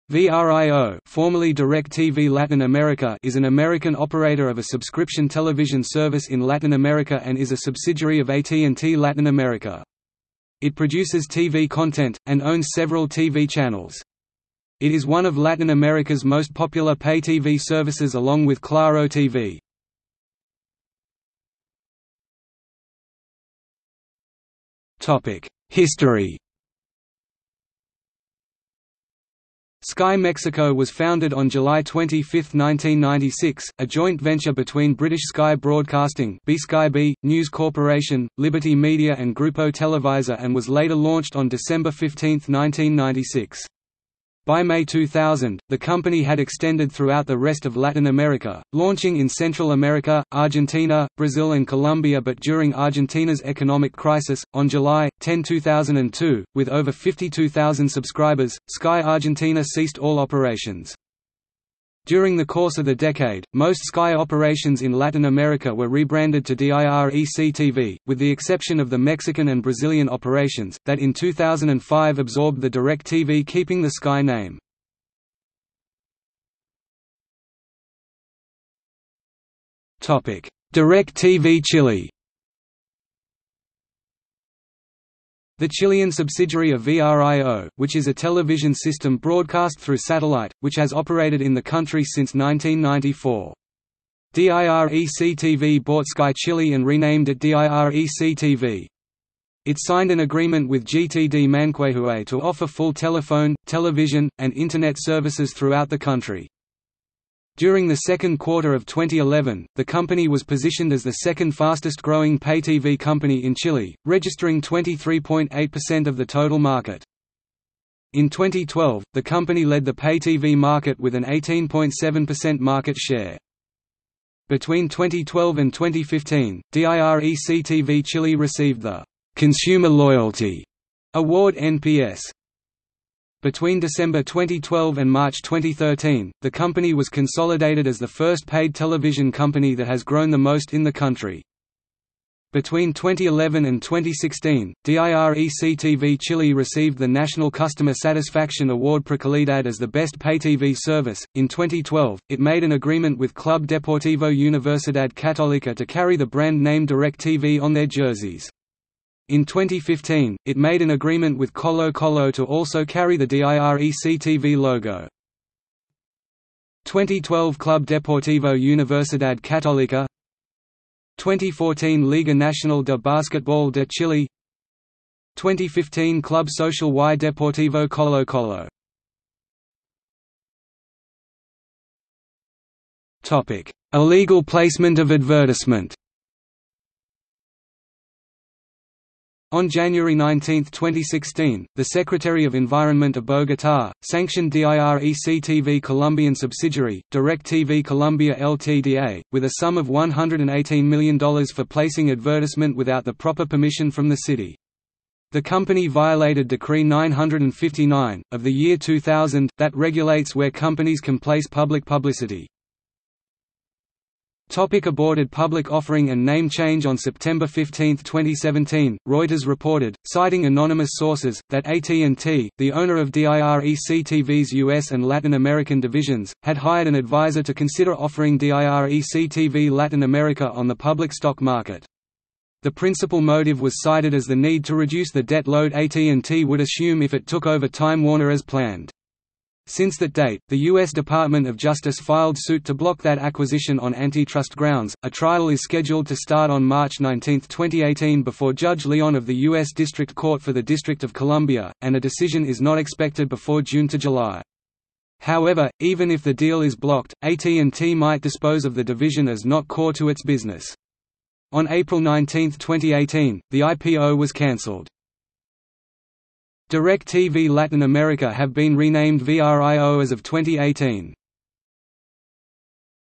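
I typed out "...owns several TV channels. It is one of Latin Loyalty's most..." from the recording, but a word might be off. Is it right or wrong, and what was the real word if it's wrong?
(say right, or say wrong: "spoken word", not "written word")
wrong: "America", not "Loyalty".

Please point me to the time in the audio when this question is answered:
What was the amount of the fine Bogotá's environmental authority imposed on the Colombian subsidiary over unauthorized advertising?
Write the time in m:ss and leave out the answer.
3:19.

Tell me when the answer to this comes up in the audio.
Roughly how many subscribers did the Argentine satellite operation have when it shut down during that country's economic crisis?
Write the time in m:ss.
0:56.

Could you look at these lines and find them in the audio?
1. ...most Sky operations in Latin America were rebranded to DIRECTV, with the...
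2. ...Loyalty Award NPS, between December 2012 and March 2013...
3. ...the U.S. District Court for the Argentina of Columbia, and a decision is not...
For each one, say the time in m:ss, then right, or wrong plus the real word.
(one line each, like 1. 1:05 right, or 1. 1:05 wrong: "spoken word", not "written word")
1. 1:03 right
2. 2:09 right
3. 4:09 wrong: "District", not "Argentina".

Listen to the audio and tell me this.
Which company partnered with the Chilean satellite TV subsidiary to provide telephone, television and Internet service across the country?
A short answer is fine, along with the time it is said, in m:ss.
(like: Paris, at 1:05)
GTD Manquehue, at 1:40.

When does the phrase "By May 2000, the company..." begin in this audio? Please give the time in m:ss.
0:44.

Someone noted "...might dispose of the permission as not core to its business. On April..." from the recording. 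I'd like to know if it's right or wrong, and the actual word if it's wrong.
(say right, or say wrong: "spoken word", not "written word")
wrong: "division", not "permission".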